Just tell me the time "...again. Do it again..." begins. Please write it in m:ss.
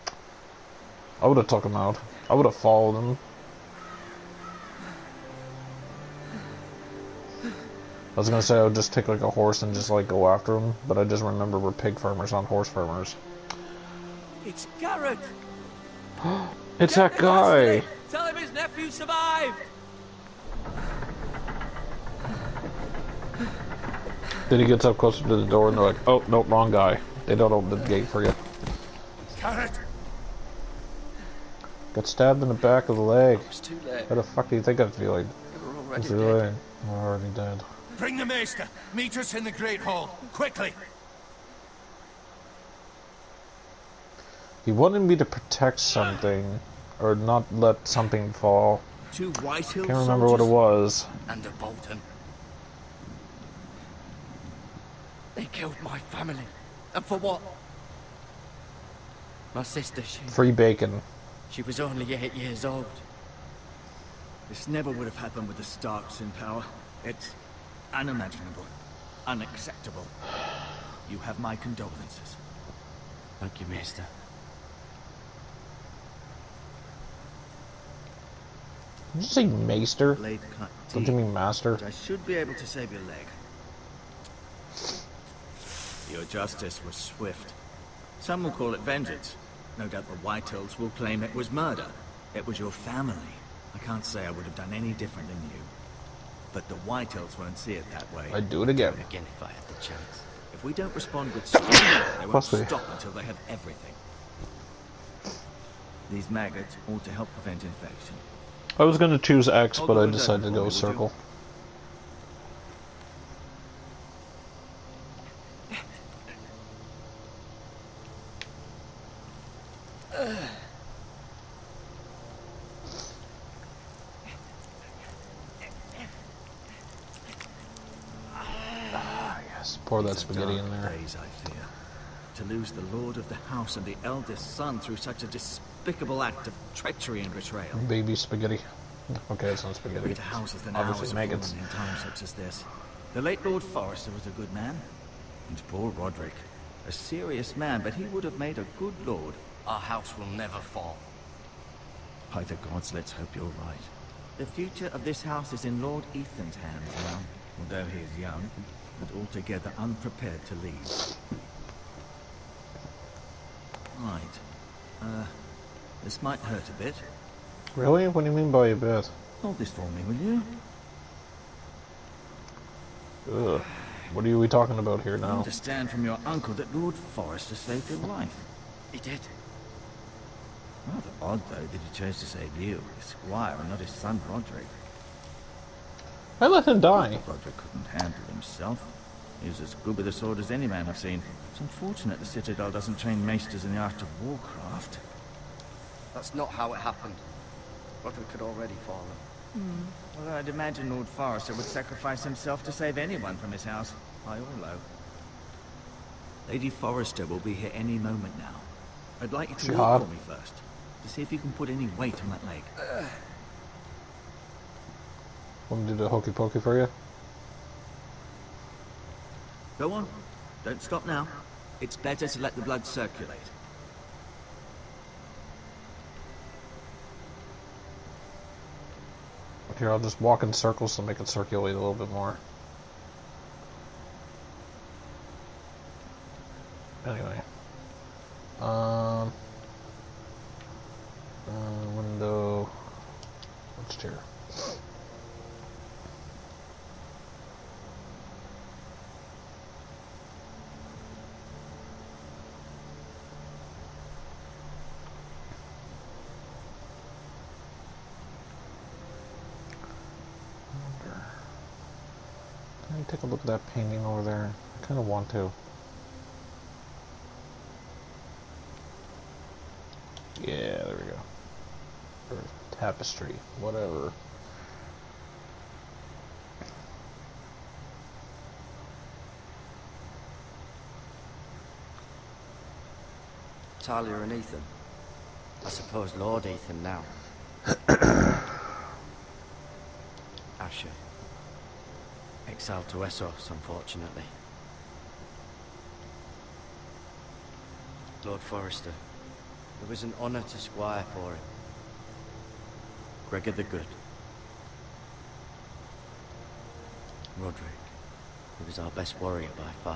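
1:38.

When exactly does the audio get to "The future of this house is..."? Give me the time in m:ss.
2:34.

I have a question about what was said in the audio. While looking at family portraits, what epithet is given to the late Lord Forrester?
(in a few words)
Gregor the Good.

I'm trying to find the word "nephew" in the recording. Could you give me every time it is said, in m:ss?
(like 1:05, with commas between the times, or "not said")
0:18.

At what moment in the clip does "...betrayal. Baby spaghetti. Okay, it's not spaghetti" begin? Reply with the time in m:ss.
2:17.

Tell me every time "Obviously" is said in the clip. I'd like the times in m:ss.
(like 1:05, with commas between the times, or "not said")
2:20.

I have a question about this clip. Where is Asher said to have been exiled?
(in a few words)
Essos.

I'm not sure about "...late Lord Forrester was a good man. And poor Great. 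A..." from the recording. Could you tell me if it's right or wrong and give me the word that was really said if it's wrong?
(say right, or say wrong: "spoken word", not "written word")
wrong: "Rodrik", not "Great".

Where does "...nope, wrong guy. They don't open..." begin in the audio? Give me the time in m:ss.
0:26.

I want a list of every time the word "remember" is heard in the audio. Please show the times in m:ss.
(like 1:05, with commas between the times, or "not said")
0:11, 0:49.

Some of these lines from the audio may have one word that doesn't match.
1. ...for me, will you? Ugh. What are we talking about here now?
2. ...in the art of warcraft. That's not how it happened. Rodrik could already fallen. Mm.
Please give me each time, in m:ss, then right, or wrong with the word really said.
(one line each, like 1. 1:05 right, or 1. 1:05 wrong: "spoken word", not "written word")
1. 2:49 right
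2. 3:13 right.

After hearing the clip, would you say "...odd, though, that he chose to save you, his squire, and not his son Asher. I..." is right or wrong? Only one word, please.
wrong.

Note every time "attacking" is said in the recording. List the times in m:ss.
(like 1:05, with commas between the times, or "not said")
not said.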